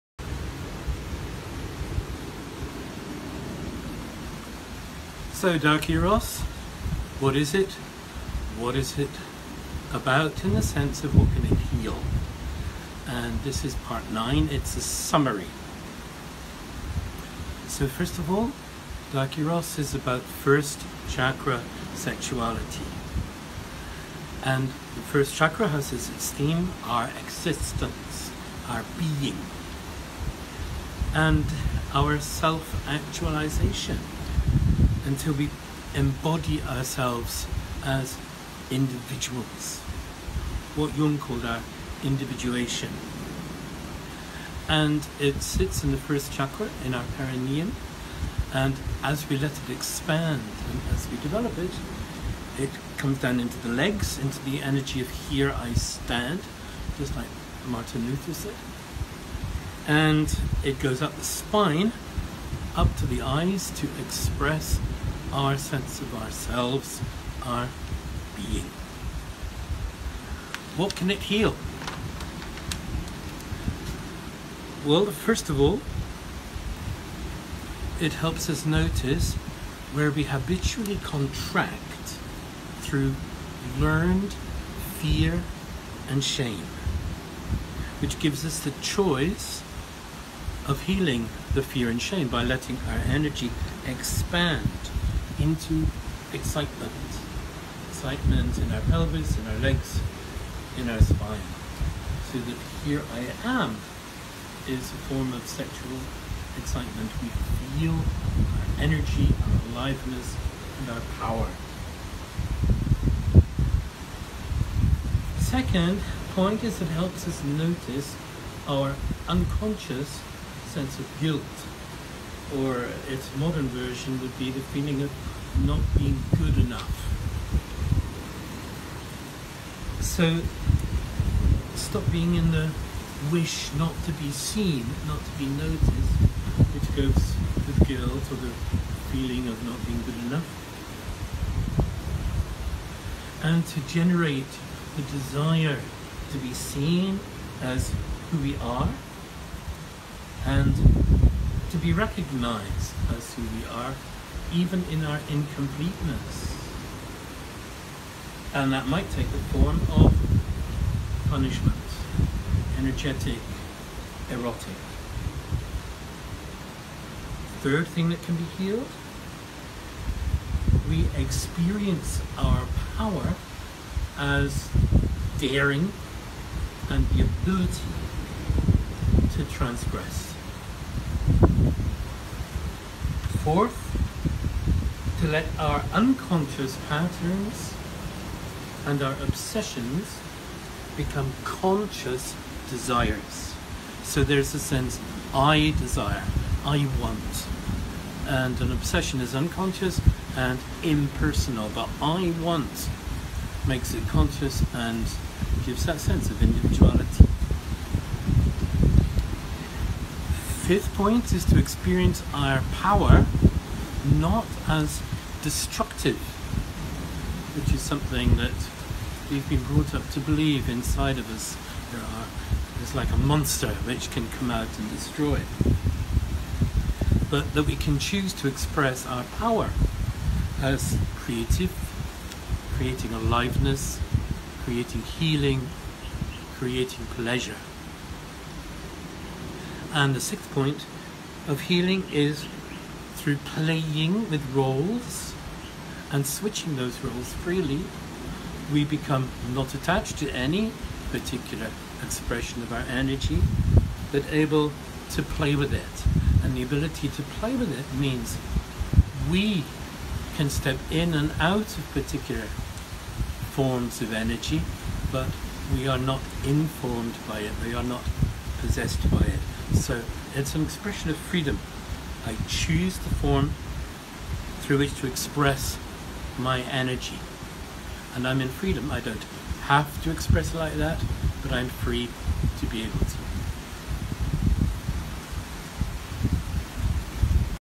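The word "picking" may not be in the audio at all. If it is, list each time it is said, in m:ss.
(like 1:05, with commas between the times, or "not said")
not said.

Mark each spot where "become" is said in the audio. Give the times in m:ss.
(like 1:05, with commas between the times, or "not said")
3:10, 4:08.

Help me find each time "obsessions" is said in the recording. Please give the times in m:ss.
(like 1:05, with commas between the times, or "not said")
3:09, 3:18.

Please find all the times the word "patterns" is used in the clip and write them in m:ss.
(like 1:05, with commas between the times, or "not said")
3:06.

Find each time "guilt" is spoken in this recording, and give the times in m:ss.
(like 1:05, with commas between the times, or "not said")
2:01, 2:17.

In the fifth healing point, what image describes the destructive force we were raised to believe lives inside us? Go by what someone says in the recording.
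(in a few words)
a monster.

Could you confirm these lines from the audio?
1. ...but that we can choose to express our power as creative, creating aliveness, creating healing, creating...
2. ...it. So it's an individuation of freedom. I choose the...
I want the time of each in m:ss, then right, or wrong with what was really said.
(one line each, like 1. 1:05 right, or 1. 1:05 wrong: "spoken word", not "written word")
1. 3:47 right
2. 4:29 wrong: "expression", not "individuation".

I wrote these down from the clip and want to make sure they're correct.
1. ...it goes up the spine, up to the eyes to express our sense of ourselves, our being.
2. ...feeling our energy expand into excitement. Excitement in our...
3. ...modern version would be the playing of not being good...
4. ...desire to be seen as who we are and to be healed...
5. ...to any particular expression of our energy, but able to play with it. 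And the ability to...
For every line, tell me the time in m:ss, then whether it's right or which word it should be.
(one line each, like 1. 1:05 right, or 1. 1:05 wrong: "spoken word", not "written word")
1. 1:00 right
2. 1:32 wrong: "letting", not "feeling"
3. 2:03 wrong: "feeling", not "playing"
4. 2:25 wrong: "recognized", not "healed"
5. 4:10 right.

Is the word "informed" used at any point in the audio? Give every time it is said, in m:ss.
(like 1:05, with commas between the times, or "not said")
4:26.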